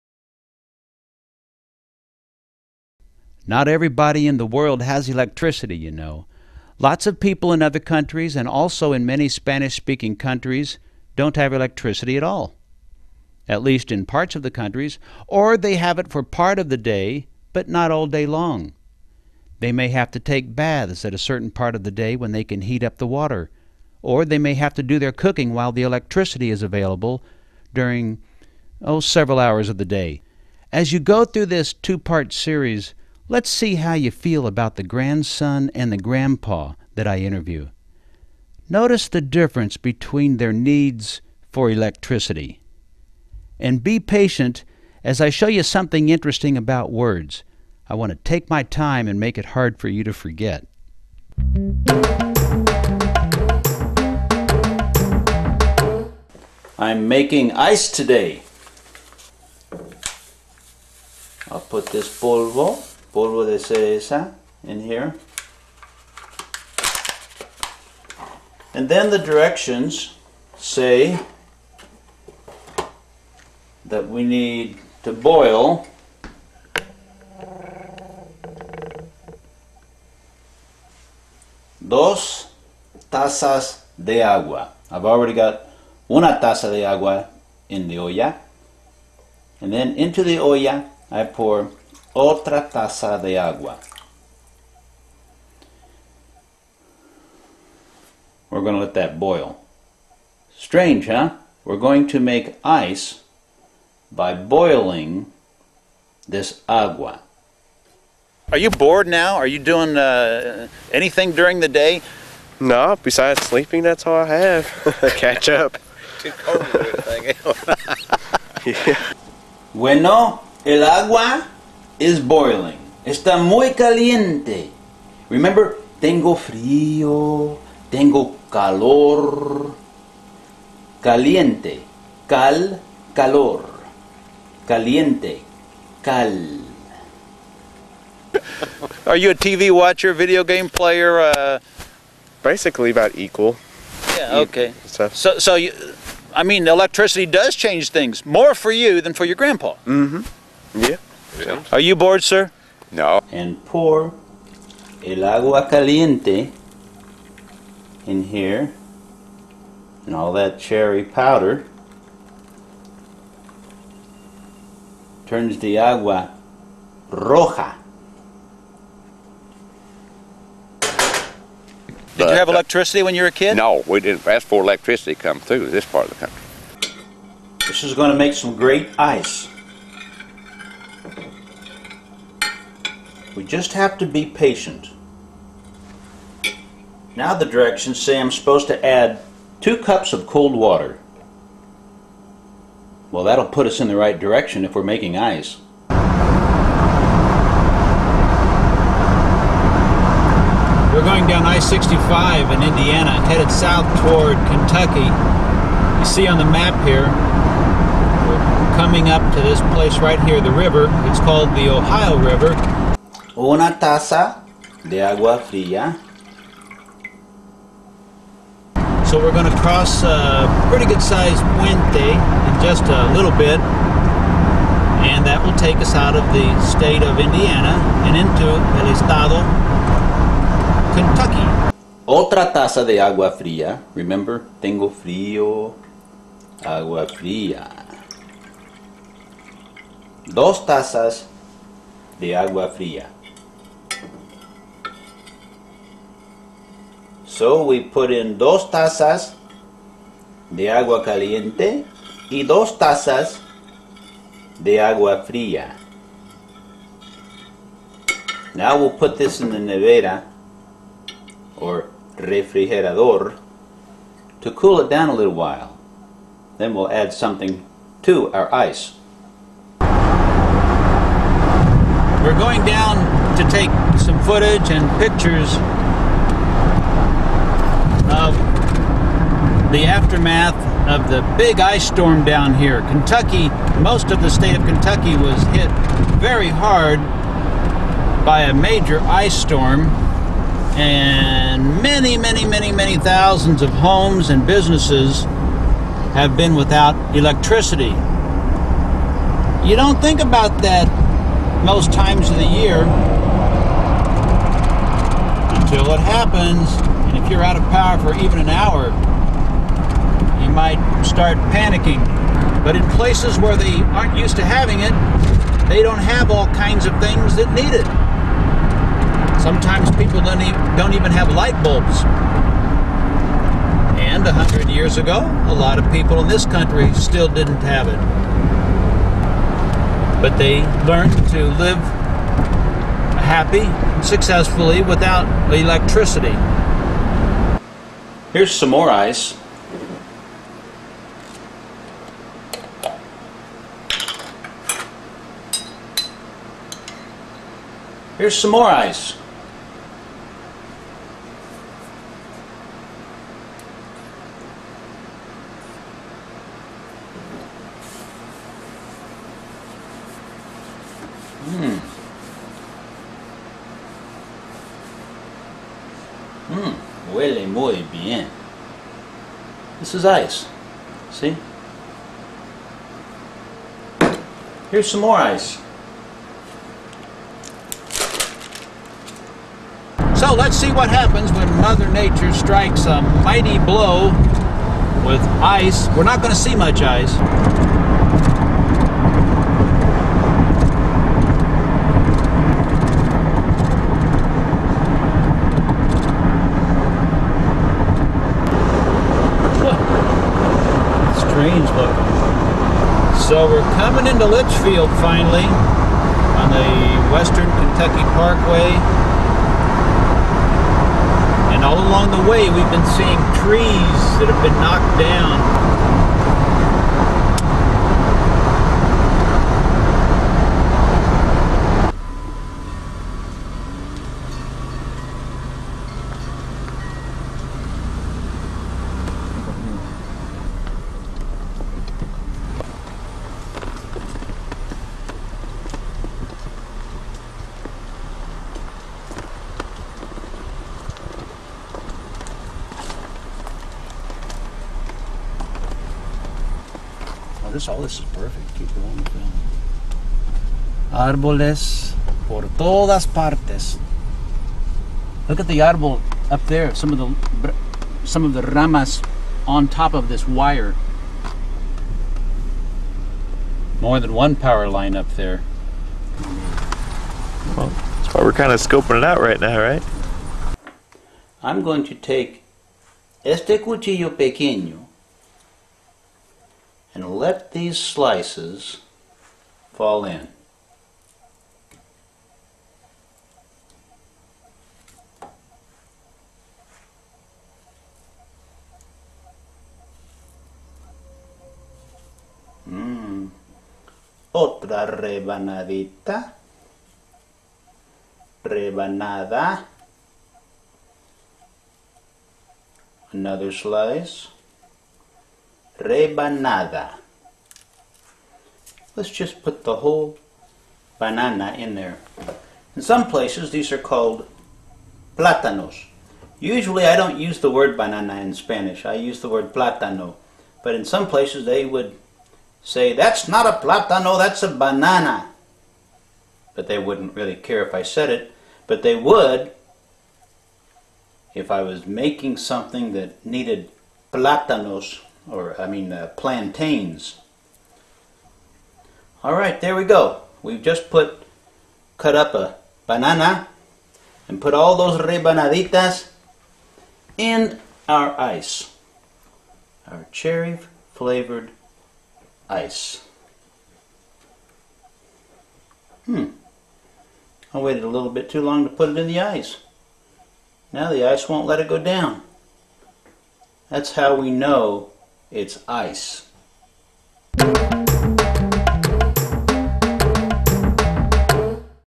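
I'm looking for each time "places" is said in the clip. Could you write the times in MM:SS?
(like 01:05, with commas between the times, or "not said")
03:29, 05:12, 08:33, 08:41.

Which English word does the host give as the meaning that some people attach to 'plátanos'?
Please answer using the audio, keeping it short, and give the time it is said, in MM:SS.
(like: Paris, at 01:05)
plantains, at 08:56.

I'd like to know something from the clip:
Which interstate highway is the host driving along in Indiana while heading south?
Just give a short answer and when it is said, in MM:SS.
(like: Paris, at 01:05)
I-65, at 03:21.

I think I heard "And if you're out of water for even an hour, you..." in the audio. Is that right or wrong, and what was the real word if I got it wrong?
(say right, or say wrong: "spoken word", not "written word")
wrong: "power", not "water".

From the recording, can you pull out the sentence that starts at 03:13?
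Well, that'll put us in the right direction if we're making ice.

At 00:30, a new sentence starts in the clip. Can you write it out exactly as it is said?
As you go through this two part series, Let's see how you feel about the grandson and the grandpa that I interview.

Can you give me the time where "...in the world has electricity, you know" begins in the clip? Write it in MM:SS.
00:04.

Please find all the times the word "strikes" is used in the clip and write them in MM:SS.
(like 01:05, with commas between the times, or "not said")
06:22.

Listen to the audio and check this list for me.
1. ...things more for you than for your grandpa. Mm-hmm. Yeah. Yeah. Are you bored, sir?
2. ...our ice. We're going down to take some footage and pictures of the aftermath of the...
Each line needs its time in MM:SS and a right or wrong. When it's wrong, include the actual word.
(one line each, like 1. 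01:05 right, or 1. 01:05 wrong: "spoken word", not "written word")
1. 02:27 right
2. 04:28 right.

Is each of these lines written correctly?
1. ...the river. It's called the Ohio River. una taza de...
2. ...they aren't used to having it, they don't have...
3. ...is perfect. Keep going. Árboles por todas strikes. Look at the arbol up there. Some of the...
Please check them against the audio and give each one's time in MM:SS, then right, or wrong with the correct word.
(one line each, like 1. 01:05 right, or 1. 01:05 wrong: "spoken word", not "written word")
1. 03:30 right
2. 05:13 right
3. 07:27 wrong: "partes", not "strikes".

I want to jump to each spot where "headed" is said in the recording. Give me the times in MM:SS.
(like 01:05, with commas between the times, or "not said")
03:23.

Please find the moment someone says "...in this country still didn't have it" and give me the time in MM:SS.
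05:26.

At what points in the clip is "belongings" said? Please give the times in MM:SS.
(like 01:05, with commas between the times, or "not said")
not said.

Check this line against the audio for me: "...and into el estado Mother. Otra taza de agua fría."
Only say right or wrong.
wrong.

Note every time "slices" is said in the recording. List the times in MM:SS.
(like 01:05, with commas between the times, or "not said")
07:57, 08:23.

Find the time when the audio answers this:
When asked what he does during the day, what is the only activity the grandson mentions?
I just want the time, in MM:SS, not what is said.
01:53.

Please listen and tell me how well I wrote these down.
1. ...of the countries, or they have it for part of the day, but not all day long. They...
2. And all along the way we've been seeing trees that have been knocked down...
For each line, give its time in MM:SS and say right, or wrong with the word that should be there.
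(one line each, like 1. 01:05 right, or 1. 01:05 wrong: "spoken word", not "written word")
1. 00:14 right
2. 06:51 right.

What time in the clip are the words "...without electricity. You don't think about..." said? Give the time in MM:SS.
04:56.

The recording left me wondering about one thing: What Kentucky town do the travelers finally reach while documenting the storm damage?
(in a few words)
Leitchfield.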